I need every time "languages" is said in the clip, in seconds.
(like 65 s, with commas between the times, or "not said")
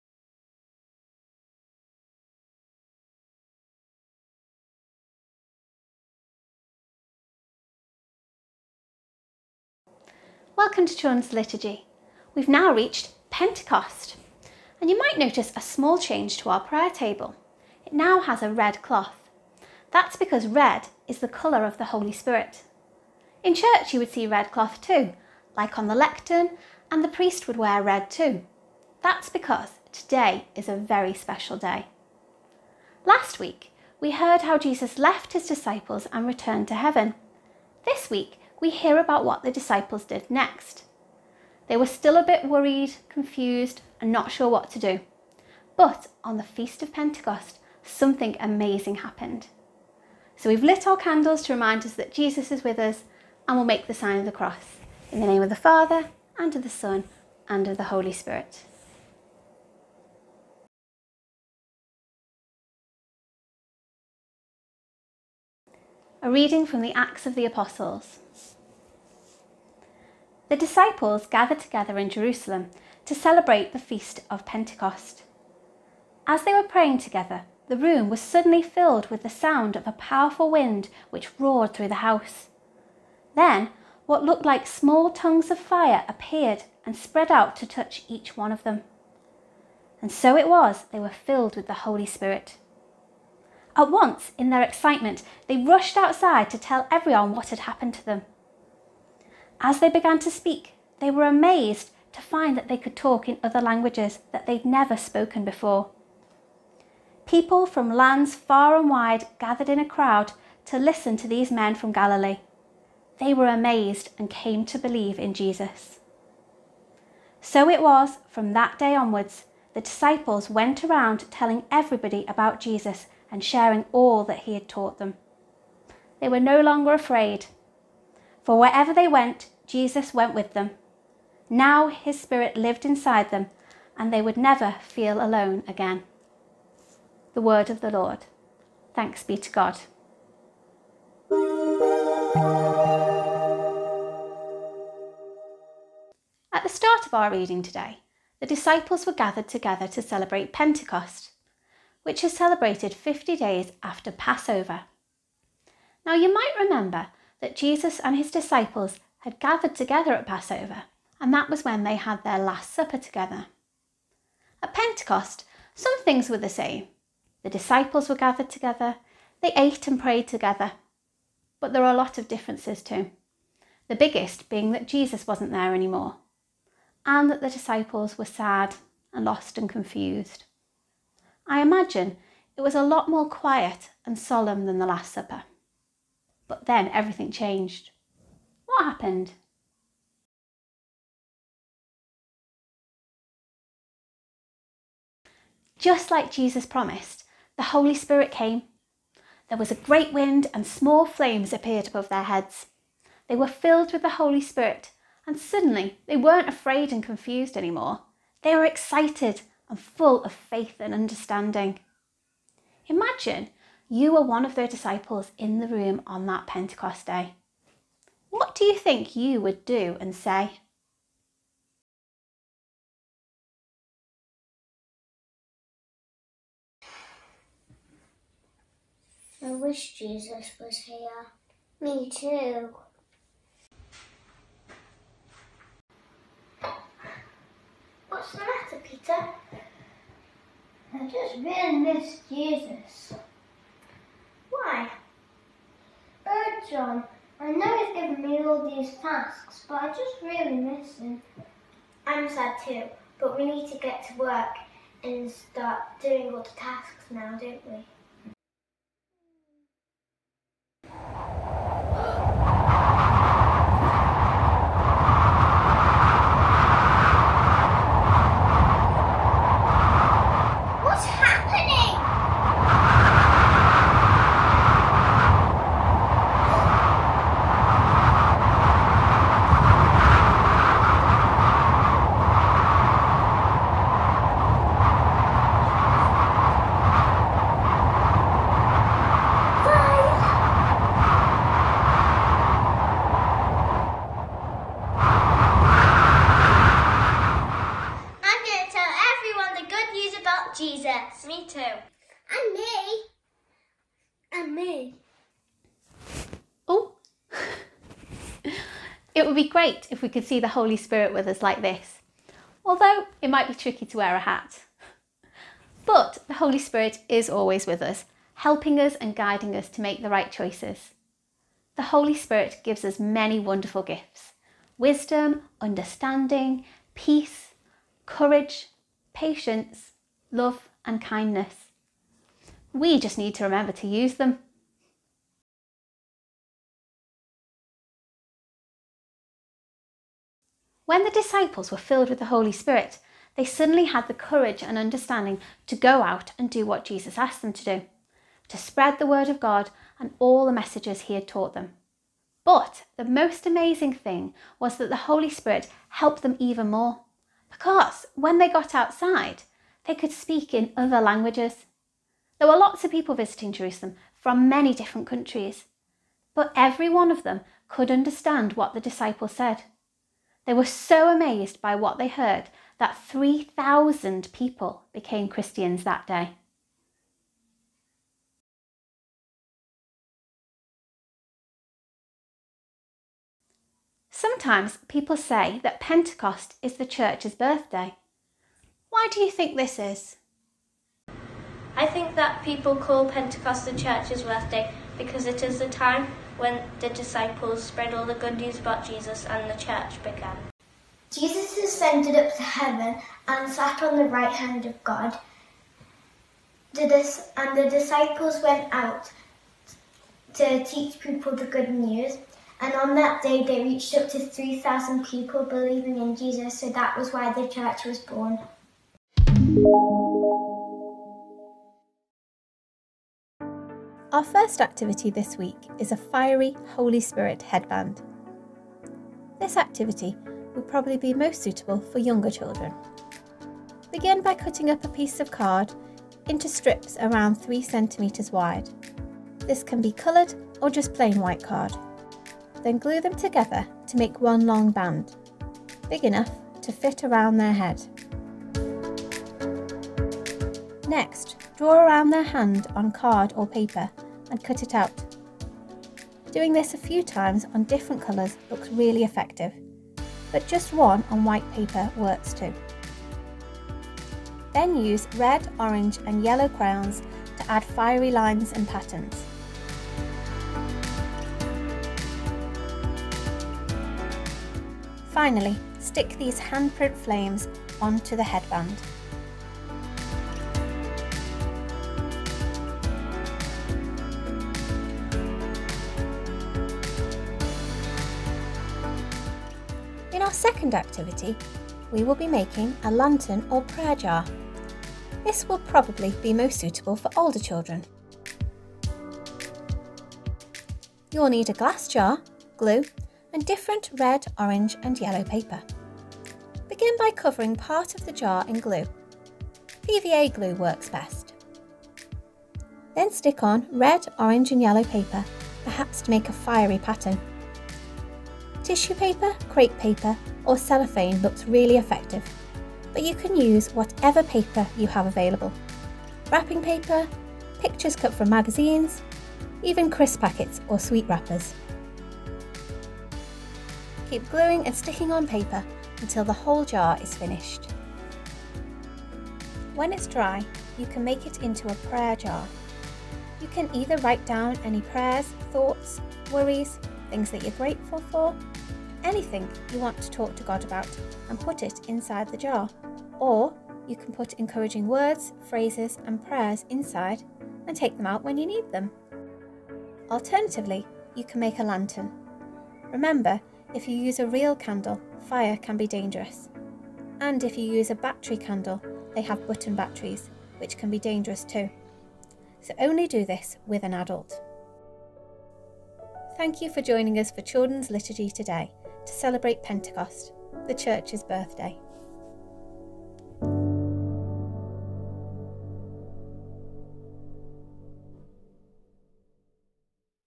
103 s, 360 s.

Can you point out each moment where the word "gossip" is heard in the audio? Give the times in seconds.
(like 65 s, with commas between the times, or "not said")
not said.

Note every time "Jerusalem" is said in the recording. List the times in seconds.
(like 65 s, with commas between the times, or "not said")
72 s, 363 s.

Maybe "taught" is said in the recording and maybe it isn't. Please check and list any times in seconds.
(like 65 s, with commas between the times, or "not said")
124 s, 351 s.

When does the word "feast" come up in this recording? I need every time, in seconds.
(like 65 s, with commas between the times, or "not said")
46 s, 73 s.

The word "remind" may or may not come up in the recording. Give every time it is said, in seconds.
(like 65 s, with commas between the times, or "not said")
51 s.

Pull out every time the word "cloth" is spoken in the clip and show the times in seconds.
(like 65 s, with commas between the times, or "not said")
18 s, 24 s.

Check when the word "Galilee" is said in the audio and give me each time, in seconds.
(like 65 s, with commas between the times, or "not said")
111 s.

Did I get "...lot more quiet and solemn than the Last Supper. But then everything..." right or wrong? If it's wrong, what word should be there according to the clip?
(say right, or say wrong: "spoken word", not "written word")
right.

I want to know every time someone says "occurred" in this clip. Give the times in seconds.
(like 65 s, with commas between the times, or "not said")
not said.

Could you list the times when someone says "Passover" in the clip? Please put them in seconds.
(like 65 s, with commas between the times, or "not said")
154 s, 160 s.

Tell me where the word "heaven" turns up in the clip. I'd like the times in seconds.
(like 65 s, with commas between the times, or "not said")
36 s, 402 s.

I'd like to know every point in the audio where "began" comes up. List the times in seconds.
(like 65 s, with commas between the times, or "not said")
99 s, 400 s.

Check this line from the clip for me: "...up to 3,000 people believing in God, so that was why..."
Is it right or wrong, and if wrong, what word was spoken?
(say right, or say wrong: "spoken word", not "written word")
wrong: "Jesus", not "God".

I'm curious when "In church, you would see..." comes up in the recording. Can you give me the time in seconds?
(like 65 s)
23 s.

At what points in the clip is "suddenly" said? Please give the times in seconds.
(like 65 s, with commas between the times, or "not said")
78 s, 205 s, 343 s.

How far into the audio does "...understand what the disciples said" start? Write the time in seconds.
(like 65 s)
367 s.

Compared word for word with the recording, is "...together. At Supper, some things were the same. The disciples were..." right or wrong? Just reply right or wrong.
wrong.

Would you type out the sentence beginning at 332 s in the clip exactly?
We just need to remember to use them.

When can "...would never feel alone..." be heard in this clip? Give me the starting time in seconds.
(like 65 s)
134 s.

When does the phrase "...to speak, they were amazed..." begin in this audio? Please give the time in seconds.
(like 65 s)
100 s.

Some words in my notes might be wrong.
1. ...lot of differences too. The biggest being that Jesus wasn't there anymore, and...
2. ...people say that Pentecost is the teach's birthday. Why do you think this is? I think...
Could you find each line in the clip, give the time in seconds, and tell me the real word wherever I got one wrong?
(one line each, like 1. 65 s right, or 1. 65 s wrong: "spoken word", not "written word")
1. 171 s right
2. 384 s wrong: "church", not "teach".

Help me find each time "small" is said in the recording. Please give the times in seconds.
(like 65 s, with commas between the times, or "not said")
15 s, 84 s, 200 s.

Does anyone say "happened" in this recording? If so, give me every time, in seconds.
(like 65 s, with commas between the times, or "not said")
48 s, 97 s, 188 s.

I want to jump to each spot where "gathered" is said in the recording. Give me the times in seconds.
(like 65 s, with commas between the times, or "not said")
71 s, 109 s, 149 s, 159 s, 168 s.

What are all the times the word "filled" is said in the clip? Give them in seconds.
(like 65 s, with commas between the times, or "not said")
78 s, 91 s, 203 s, 341 s.